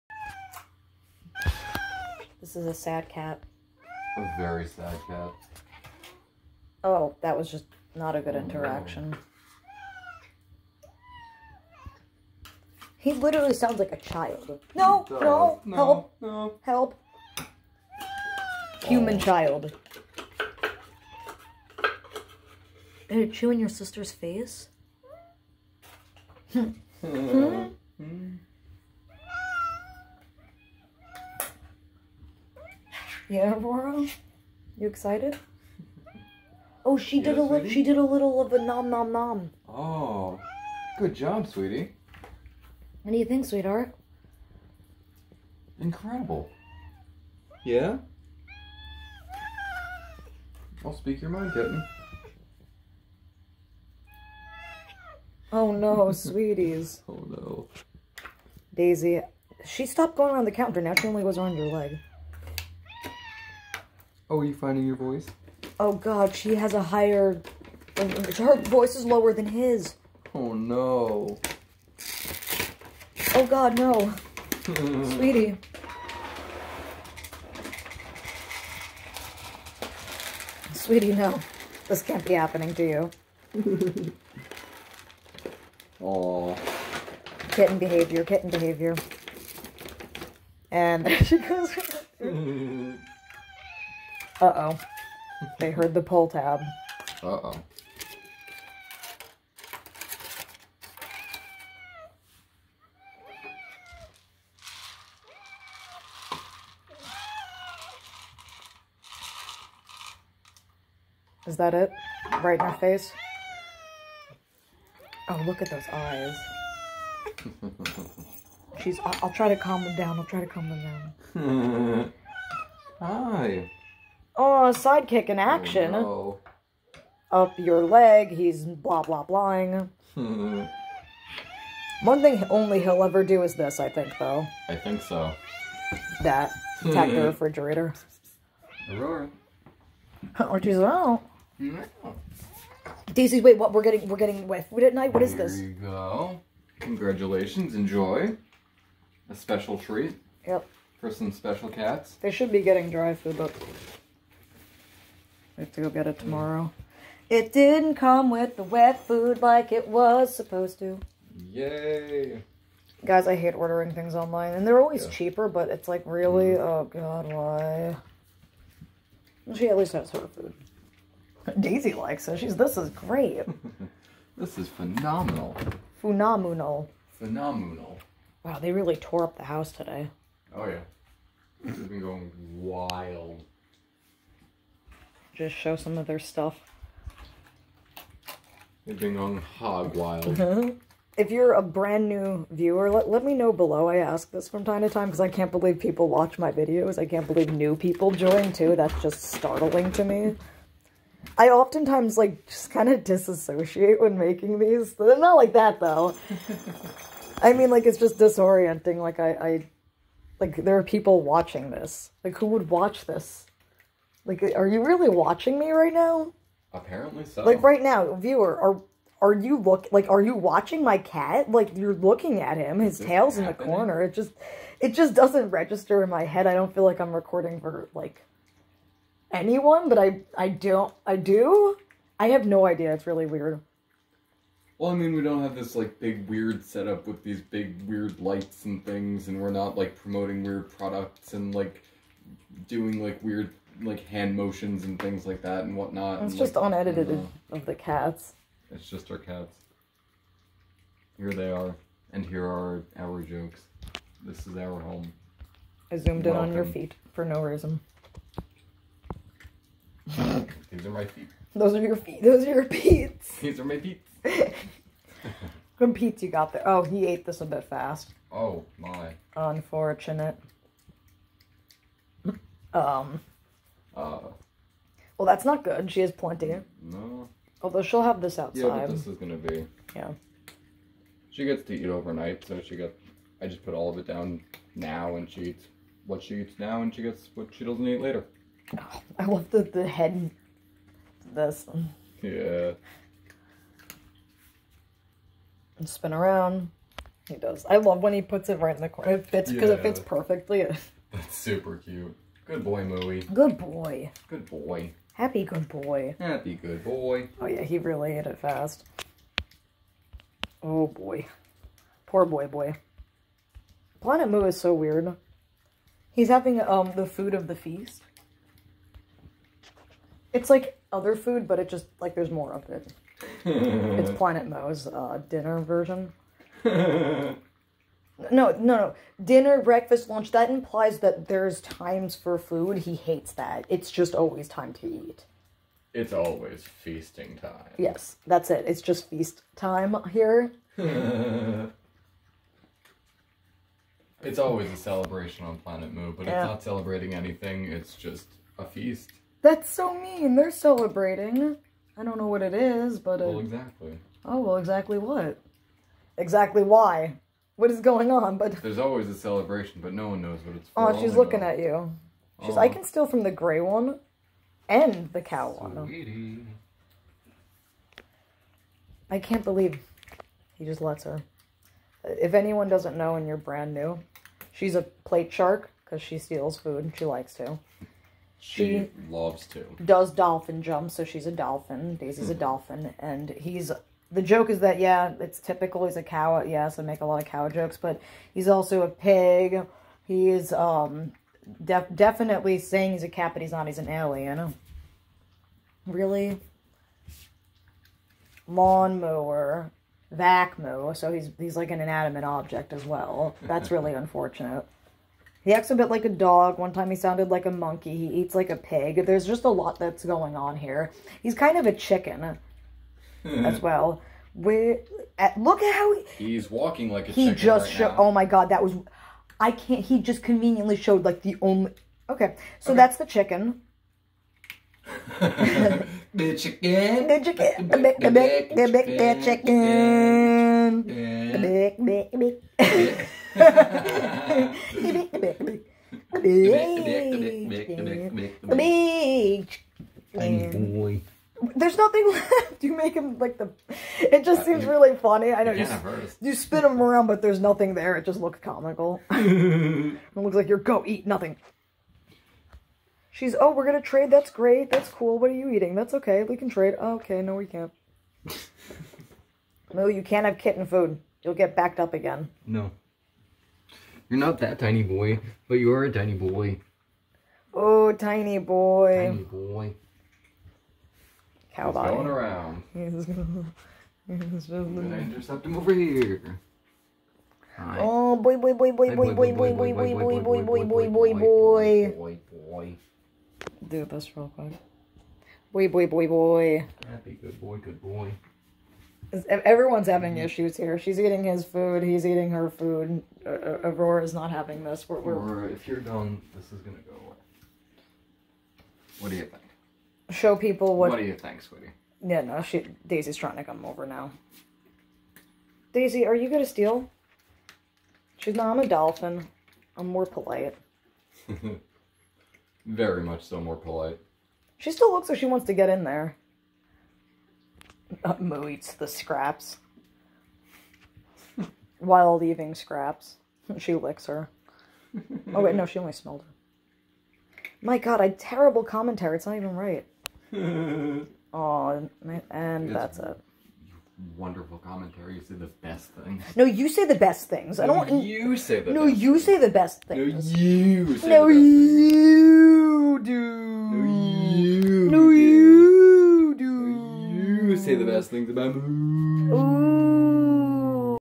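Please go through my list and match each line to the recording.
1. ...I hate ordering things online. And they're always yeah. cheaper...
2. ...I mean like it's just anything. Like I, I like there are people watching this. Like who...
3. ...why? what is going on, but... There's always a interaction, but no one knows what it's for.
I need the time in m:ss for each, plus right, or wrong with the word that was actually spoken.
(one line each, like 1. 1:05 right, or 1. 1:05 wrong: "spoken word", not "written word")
1. 2:43 right
2. 3:27 wrong: "disorienting", not "anything"
3. 5:56 wrong: "celebration", not "interaction".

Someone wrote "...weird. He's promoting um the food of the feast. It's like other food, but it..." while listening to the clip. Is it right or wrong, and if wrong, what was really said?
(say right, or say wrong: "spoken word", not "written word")
wrong: "having", not "promoting".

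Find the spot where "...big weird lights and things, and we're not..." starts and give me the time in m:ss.
3:57.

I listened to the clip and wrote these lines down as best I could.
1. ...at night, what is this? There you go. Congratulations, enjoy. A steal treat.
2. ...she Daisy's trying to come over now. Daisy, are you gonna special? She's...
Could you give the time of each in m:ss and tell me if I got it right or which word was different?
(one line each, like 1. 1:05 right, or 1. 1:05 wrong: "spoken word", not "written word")
1. 2:24 wrong: "special", not "steal"
2. 8:22 wrong: "steal", not "special".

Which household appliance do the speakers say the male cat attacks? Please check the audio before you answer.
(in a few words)
Refrigerator.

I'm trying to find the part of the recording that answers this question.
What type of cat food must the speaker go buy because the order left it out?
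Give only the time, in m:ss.
2:32.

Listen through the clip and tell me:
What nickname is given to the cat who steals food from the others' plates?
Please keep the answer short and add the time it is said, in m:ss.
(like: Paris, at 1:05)
Plate shark, at 6:14.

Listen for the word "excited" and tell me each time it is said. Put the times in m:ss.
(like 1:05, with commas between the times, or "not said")
0:34.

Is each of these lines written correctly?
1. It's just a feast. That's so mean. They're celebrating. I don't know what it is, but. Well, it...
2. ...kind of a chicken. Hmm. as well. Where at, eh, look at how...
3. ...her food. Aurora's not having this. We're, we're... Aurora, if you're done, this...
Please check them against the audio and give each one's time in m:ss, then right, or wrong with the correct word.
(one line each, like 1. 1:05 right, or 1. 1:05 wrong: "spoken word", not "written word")
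1. 5:47 right
2. 6:51 right
3. 8:12 right.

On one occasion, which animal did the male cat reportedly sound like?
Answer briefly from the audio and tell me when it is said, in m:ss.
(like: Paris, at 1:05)
Monkey, at 6:47.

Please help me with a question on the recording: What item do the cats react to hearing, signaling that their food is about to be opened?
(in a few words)
Pull tab.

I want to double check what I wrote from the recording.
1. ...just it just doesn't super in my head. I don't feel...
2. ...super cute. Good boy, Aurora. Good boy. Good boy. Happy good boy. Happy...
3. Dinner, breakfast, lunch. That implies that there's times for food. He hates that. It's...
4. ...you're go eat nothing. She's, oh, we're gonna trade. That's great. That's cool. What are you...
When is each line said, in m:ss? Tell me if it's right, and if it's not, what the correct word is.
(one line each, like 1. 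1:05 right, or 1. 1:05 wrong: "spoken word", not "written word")
1. 3:44 wrong: "register", not "super"
2. 5:01 wrong: "Mooey", not "Aurora"
3. 5:29 right
4. 7:30 right.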